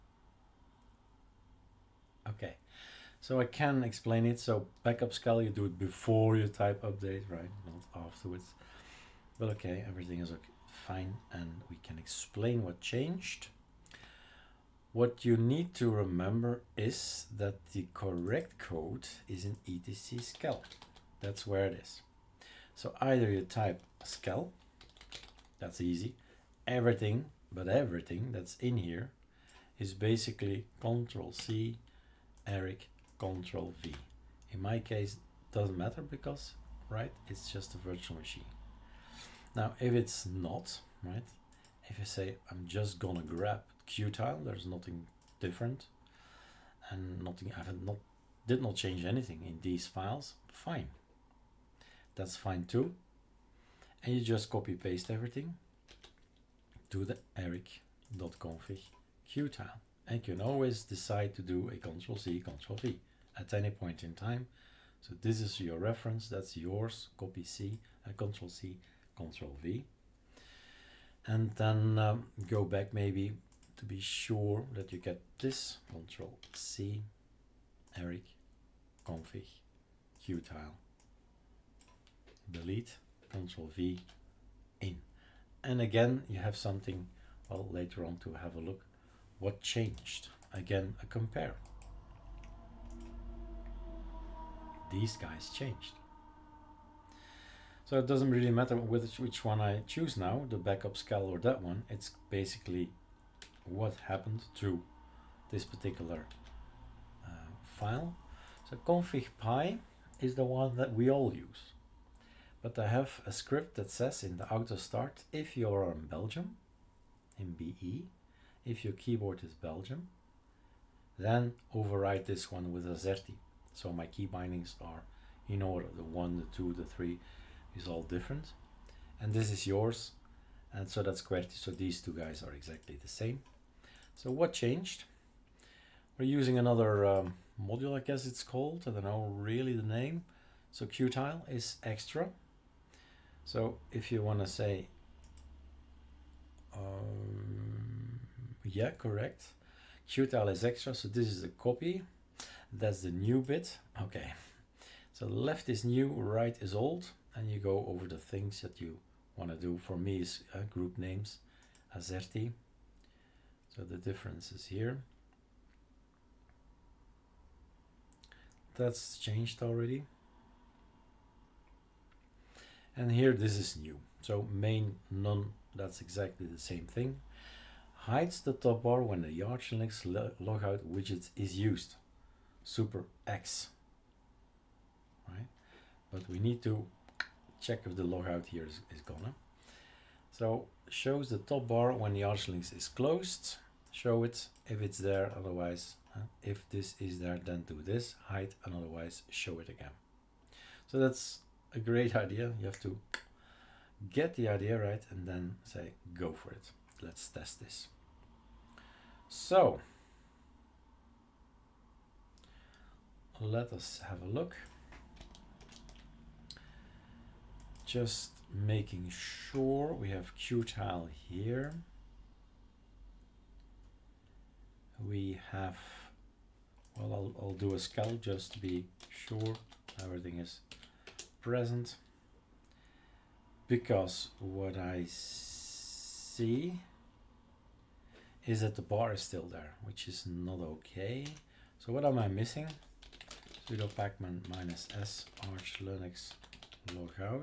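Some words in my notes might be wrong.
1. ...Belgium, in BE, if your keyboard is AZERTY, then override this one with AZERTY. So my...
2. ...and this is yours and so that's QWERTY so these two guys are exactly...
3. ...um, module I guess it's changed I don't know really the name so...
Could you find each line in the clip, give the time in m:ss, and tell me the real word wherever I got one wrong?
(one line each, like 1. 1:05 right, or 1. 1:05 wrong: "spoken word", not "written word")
1. 1:56 wrong: "Belgium", not "AZERTY"
2. 2:09 right
3. 2:17 wrong: "called", not "changed".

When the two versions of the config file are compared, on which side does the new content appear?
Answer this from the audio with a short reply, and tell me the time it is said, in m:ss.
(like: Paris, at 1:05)
Left, at 2:35.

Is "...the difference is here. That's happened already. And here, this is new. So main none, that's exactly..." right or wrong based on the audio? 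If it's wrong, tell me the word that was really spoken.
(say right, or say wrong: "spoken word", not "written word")
wrong: "changed", not "happened".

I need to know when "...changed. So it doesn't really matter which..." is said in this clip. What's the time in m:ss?
1:35.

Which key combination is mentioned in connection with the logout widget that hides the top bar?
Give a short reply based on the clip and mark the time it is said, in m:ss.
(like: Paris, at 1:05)
Super X, at 3:02.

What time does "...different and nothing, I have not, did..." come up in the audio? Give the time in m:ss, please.
0:45.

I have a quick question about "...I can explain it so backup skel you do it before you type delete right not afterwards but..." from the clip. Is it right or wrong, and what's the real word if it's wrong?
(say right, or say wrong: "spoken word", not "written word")
wrong: "update", not "delete".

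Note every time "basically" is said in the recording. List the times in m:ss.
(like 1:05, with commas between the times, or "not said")
0:29, 1:42.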